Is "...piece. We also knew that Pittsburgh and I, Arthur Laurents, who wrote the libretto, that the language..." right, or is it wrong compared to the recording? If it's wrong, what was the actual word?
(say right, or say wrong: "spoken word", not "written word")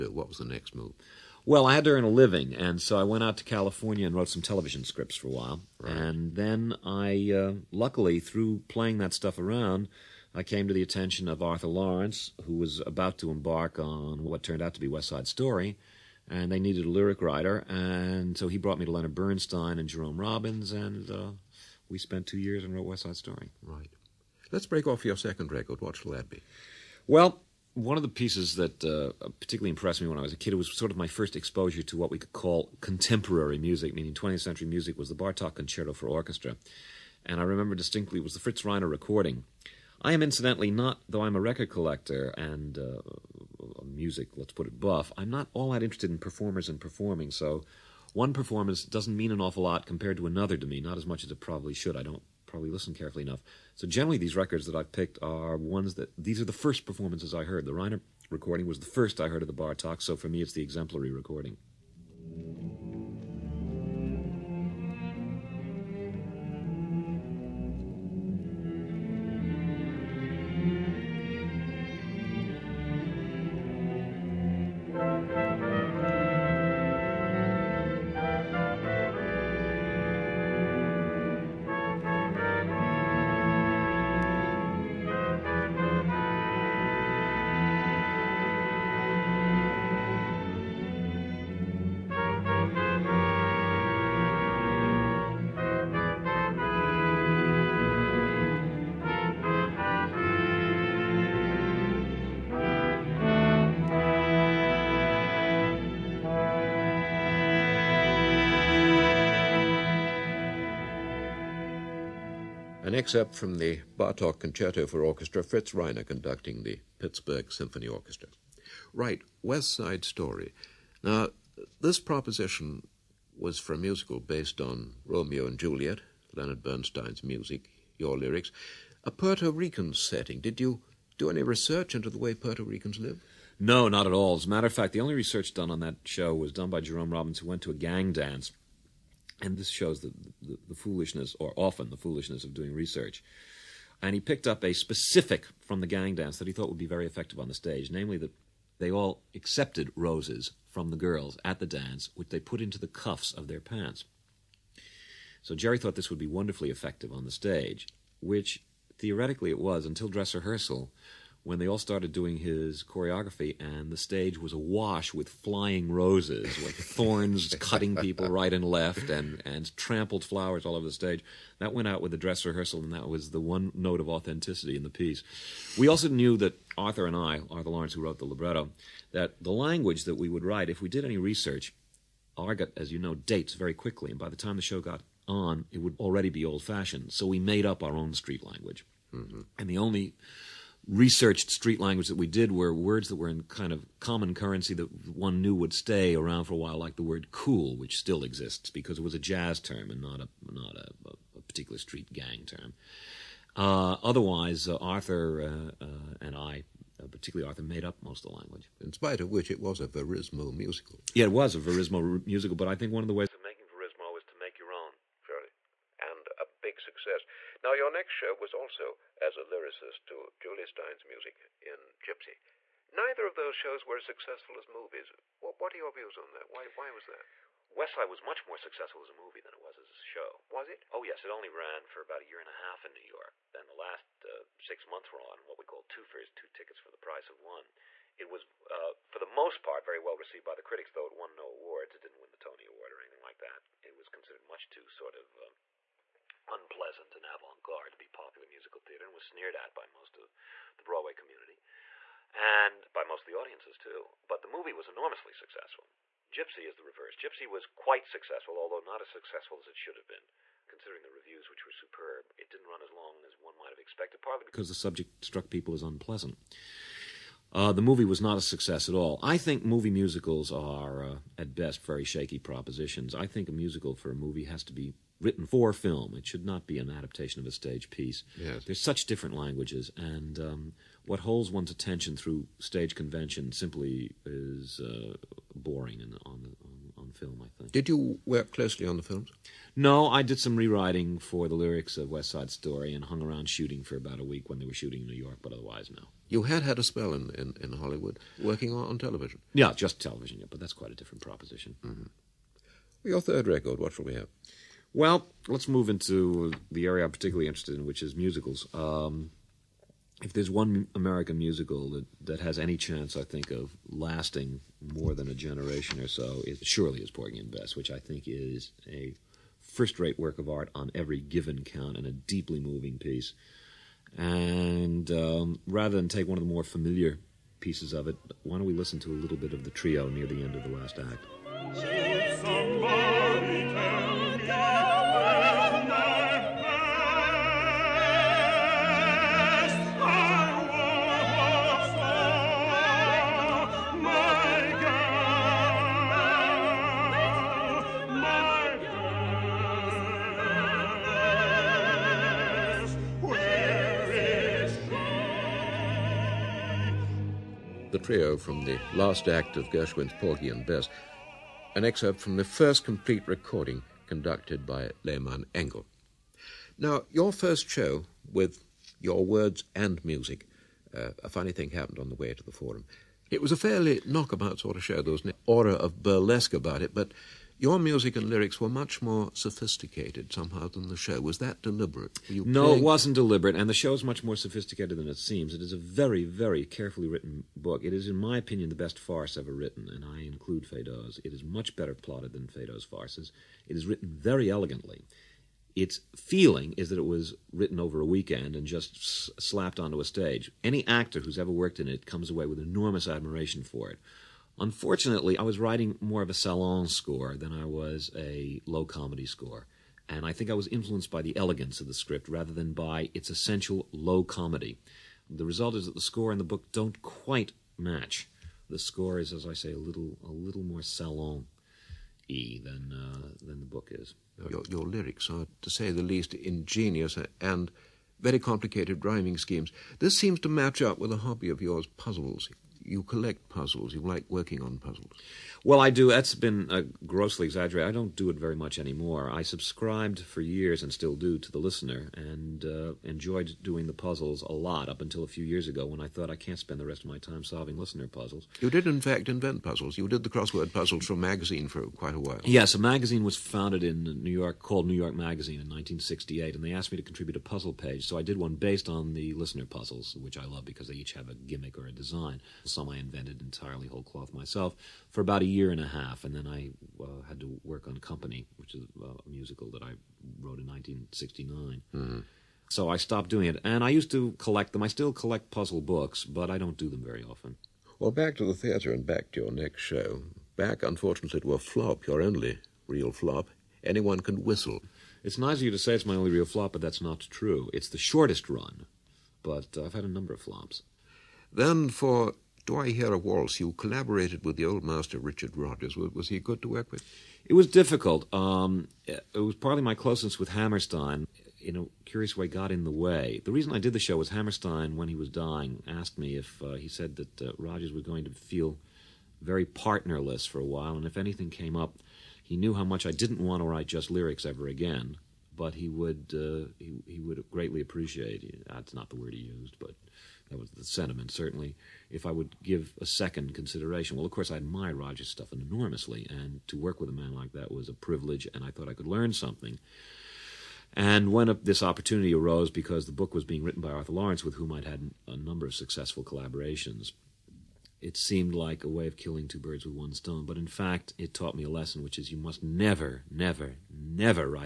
wrong: "Arthur", not "Pittsburgh".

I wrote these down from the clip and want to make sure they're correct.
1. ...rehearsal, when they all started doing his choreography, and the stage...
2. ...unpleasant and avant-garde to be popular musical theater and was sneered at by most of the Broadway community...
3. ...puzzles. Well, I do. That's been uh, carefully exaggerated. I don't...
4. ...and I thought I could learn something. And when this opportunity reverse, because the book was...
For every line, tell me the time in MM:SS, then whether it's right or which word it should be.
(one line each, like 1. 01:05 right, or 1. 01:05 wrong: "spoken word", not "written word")
1. 02:40 right
2. 04:06 right
3. 07:14 wrong: "grossly", not "carefully"
4. 08:48 wrong: "arose", not "reverse".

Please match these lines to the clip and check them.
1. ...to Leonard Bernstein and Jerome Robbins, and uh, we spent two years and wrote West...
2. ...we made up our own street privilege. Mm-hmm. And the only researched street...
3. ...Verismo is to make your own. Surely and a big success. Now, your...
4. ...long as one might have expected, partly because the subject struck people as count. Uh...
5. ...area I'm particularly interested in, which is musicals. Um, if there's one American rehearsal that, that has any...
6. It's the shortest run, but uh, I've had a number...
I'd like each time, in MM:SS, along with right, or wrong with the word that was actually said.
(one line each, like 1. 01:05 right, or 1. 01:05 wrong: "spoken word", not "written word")
1. 00:18 right
2. 03:07 wrong: "language", not "privilege"
3. 03:33 right
4. 04:22 wrong: "unpleasant", not "count"
5. 05:06 wrong: "musical", not "rehearsal"
6. 08:07 right.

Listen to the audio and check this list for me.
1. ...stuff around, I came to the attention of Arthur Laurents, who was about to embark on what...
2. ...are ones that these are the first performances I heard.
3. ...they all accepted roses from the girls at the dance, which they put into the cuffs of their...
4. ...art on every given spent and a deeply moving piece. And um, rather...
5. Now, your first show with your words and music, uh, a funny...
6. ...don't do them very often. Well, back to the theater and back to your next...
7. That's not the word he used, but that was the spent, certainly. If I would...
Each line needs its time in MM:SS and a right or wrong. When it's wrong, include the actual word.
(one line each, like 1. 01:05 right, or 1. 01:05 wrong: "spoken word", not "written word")
1. 00:09 right
2. 00:55 right
3. 02:28 right
4. 05:20 wrong: "count", not "spent"
5. 06:06 right
6. 07:56 right
7. 08:38 wrong: "sentiment", not "spent".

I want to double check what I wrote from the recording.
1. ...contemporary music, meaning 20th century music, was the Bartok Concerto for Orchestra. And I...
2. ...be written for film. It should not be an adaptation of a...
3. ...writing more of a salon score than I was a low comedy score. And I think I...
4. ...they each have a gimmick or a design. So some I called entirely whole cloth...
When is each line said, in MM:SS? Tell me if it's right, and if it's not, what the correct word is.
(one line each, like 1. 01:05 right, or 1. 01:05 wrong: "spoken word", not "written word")
1. 00:32 right
2. 04:34 right
3. 06:45 right
4. 07:40 wrong: "invented", not "called".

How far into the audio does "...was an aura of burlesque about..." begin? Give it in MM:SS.
06:15.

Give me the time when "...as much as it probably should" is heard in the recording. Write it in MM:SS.
00:50.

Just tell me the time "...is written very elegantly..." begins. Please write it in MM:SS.
06:33.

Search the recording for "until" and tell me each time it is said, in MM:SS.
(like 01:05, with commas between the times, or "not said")
02:39, 07:25.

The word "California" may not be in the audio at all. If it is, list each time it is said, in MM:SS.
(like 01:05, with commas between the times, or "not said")
00:03.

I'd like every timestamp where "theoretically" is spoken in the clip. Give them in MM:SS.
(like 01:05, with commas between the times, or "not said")
02:38.